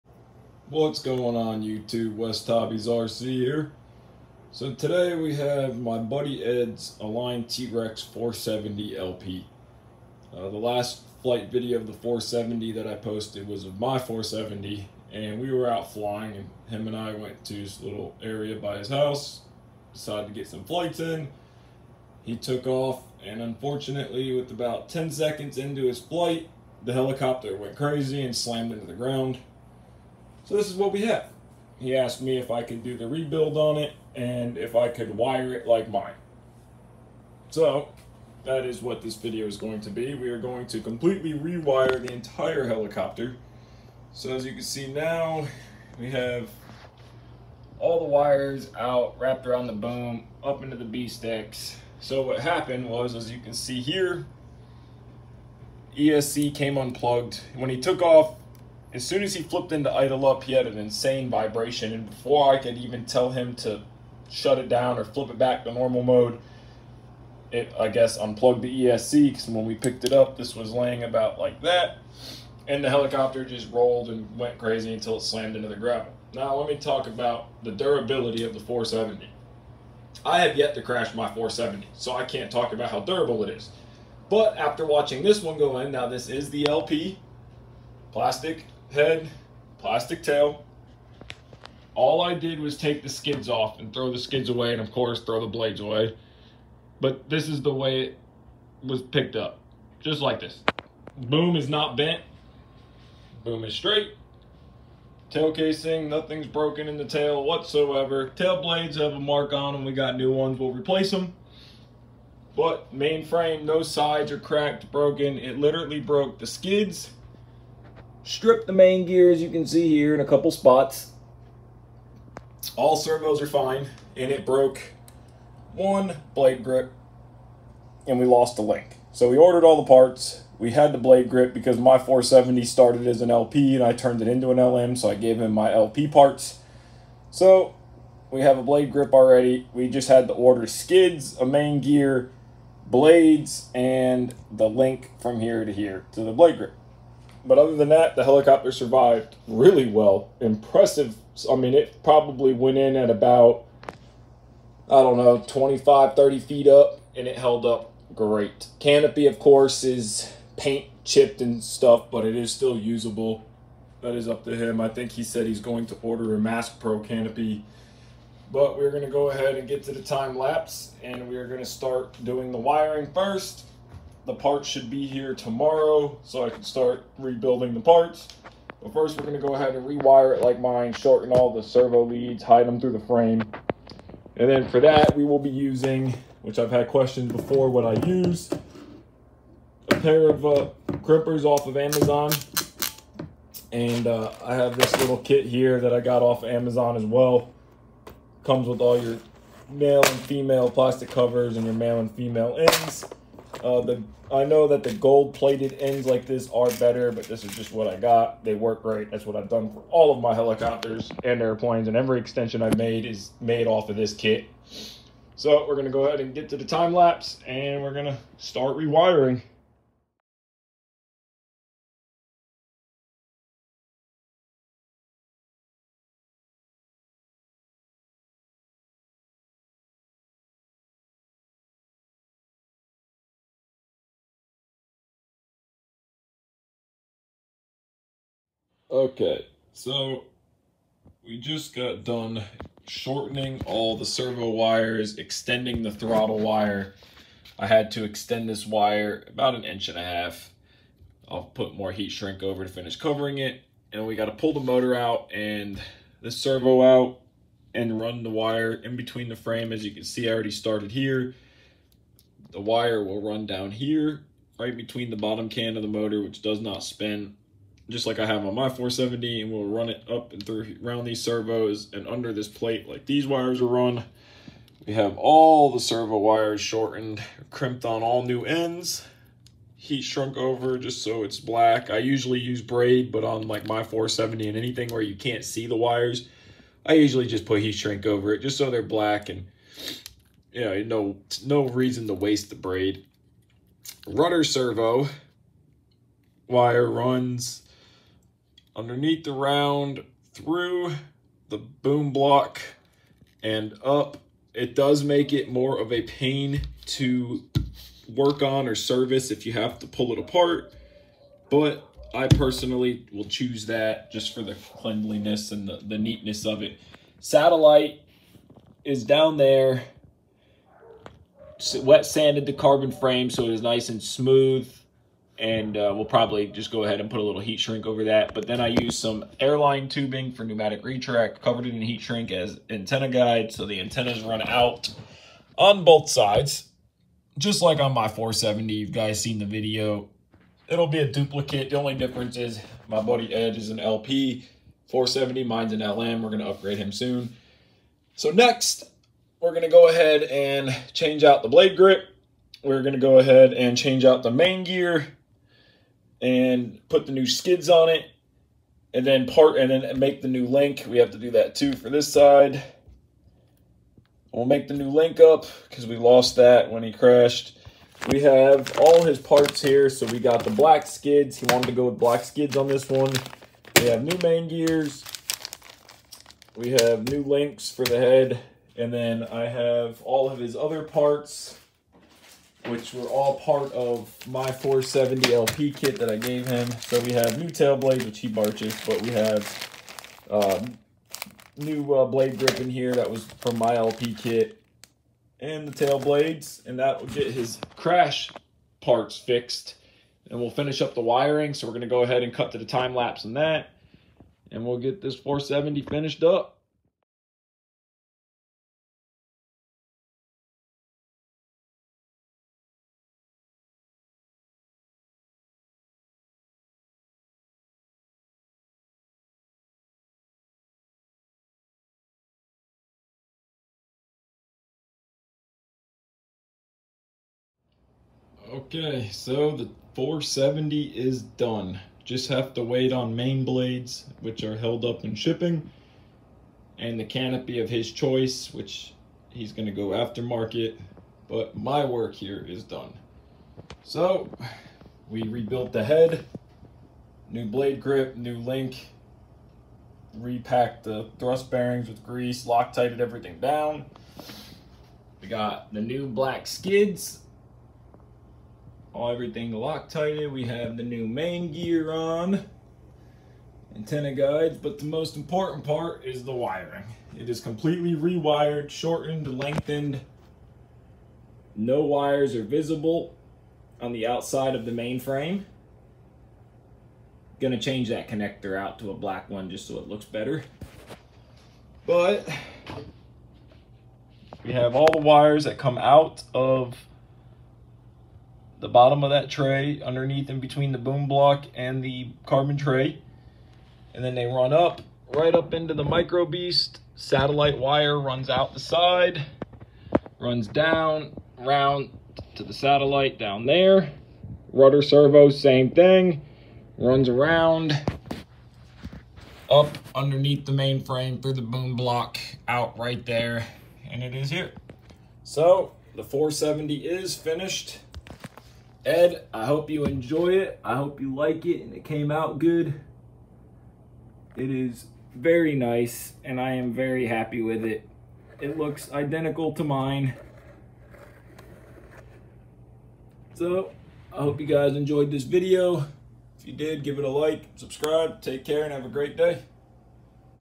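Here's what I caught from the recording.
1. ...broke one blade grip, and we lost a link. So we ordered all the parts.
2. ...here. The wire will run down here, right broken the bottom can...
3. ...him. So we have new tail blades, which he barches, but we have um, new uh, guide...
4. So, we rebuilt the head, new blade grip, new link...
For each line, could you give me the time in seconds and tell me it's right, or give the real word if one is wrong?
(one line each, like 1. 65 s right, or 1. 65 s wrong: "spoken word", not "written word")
1. 124 s right
2. 260 s wrong: "between", not "broken"
3. 386 s wrong: "blade", not "guide"
4. 443 s right.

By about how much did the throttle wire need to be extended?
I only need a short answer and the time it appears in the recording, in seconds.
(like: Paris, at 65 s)
an inch and a half, at 249 s.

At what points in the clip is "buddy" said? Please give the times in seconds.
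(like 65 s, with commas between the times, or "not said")
5 s, 343 s.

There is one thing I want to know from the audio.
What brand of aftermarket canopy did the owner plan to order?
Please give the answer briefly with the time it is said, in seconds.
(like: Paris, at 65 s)
Mask Pro, at 166 s.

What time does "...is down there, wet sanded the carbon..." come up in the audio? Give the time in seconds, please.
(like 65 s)
318 s.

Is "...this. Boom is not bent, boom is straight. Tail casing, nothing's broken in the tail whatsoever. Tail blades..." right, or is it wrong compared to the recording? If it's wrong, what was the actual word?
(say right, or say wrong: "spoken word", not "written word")
right.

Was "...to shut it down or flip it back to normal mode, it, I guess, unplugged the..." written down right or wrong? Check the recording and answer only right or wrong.
right.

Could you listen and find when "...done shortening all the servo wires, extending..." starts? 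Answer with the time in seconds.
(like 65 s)
242 s.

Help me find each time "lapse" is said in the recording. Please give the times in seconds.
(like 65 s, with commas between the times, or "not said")
170 s, 216 s, 402 s.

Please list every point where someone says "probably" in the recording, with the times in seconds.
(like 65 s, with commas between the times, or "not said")
152 s, 326 s.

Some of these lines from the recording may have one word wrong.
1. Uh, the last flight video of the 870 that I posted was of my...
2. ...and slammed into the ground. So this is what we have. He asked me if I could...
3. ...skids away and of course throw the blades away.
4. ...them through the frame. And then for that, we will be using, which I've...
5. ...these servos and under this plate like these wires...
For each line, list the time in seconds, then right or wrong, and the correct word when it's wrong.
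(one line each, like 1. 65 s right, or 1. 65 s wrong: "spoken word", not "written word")
1. 10 s wrong: "470", not "870"
2. 28 s right
3. 94 s right
4. 182 s right
5. 271 s right.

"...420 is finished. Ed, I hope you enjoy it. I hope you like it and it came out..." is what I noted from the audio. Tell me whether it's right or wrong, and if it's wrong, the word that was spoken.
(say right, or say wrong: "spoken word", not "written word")
wrong: "470", not "420".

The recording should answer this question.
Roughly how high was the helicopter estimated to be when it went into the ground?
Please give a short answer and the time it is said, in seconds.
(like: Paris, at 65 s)
25 to 30 feet, at 155 s.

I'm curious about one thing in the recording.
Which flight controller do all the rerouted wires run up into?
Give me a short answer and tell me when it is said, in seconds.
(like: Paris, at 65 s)
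Micro Beast, at 495 s.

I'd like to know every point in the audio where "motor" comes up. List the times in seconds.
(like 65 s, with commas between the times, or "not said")
254 s, 265 s.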